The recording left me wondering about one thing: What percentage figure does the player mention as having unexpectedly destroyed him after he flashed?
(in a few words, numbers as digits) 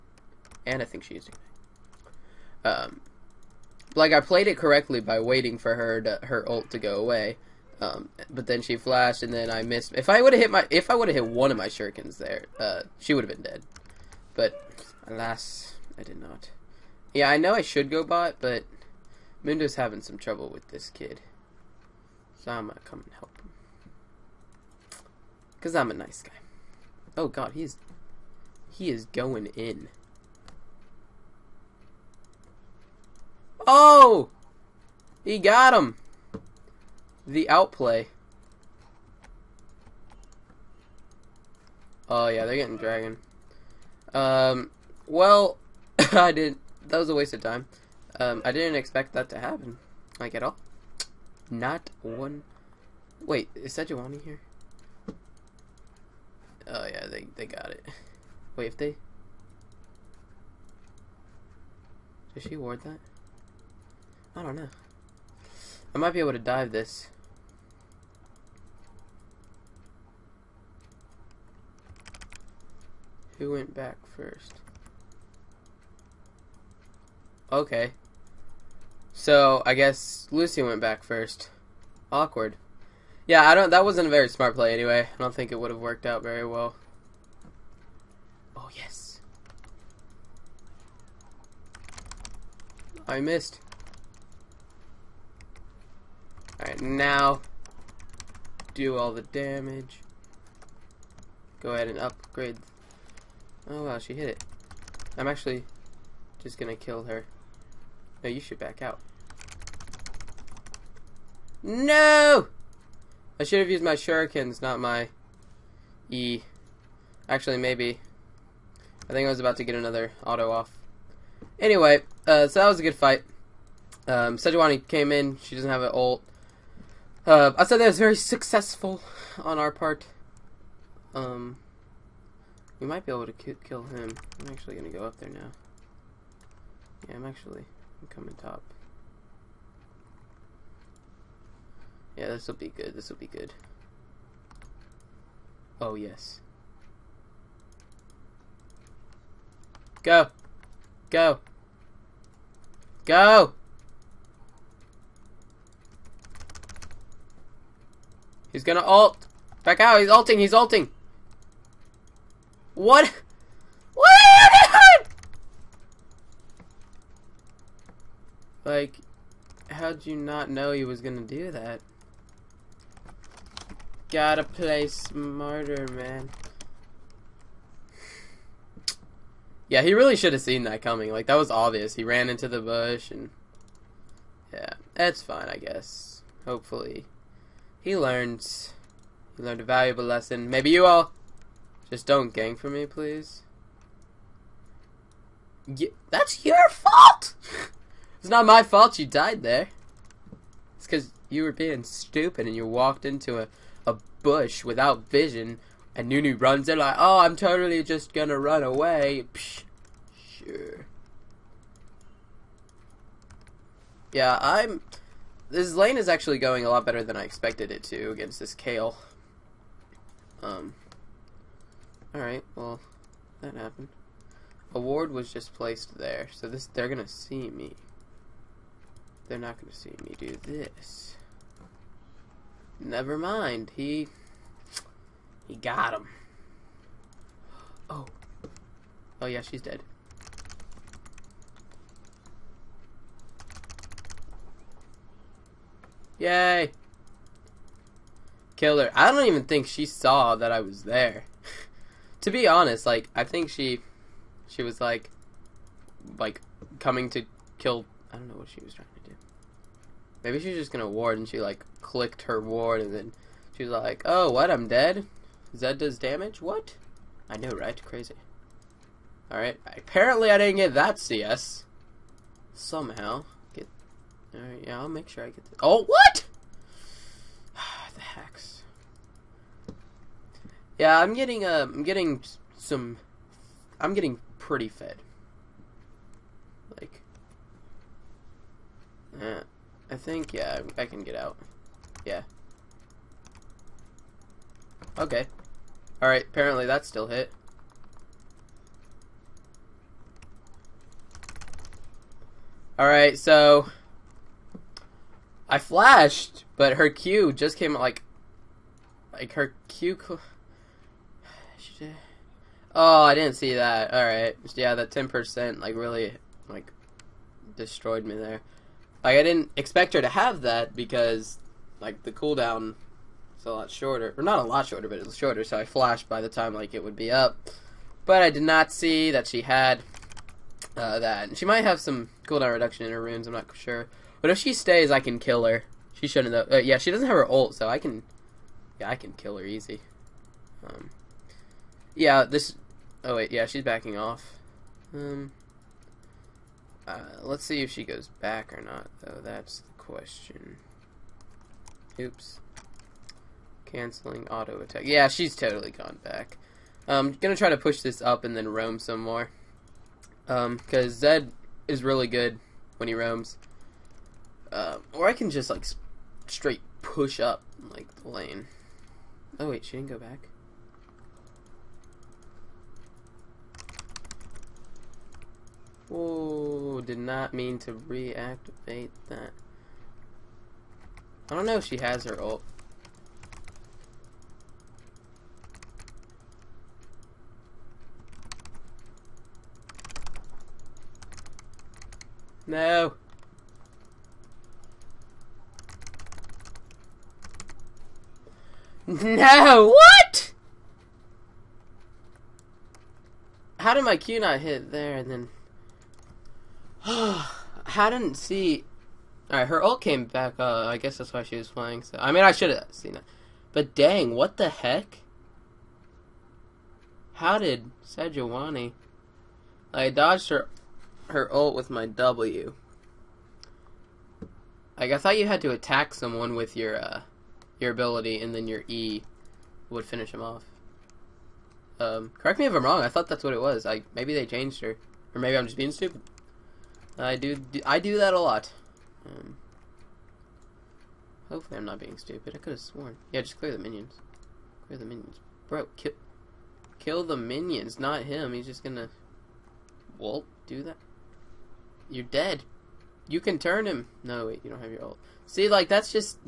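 10%.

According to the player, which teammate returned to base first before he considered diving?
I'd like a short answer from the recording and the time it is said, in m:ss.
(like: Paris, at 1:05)
Lucy, at 1:20.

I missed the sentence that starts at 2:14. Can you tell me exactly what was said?
I'm actually going to go up there now.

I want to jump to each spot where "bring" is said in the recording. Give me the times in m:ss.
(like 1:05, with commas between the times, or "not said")
not said.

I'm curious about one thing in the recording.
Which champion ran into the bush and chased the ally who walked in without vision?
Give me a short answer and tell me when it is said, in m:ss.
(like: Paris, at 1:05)
Nunu, at 3:26.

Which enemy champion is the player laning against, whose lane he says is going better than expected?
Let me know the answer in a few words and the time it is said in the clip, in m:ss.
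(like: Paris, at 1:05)
Kayle, at 3:38.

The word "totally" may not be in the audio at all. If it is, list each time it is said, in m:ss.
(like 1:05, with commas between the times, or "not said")
3:27, 5:55.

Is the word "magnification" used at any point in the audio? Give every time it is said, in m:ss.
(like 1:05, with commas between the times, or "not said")
not said.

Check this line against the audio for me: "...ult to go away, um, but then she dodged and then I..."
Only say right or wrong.
wrong.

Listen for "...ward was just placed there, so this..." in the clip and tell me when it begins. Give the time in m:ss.
3:44.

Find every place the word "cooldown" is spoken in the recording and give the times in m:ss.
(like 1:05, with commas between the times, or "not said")
5:22, 5:32.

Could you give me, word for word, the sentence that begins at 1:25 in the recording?
I don't think it would have worked out very well.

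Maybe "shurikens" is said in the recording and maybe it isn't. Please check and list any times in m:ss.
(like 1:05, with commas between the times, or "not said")
0:11, 1:53.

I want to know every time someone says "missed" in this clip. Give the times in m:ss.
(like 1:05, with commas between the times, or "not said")
0:09, 1:33.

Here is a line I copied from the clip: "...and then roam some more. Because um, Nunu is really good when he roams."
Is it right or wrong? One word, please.
wrong.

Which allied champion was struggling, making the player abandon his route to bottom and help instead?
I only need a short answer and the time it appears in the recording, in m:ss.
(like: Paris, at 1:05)
Mundo, at 0:19.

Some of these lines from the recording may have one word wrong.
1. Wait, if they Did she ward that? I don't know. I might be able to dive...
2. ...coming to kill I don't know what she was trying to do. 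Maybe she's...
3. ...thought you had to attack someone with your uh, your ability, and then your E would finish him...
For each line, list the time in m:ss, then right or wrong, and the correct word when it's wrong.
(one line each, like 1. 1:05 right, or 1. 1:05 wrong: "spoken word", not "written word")
1. 0:58 right
2. 4:16 right
3. 7:04 right.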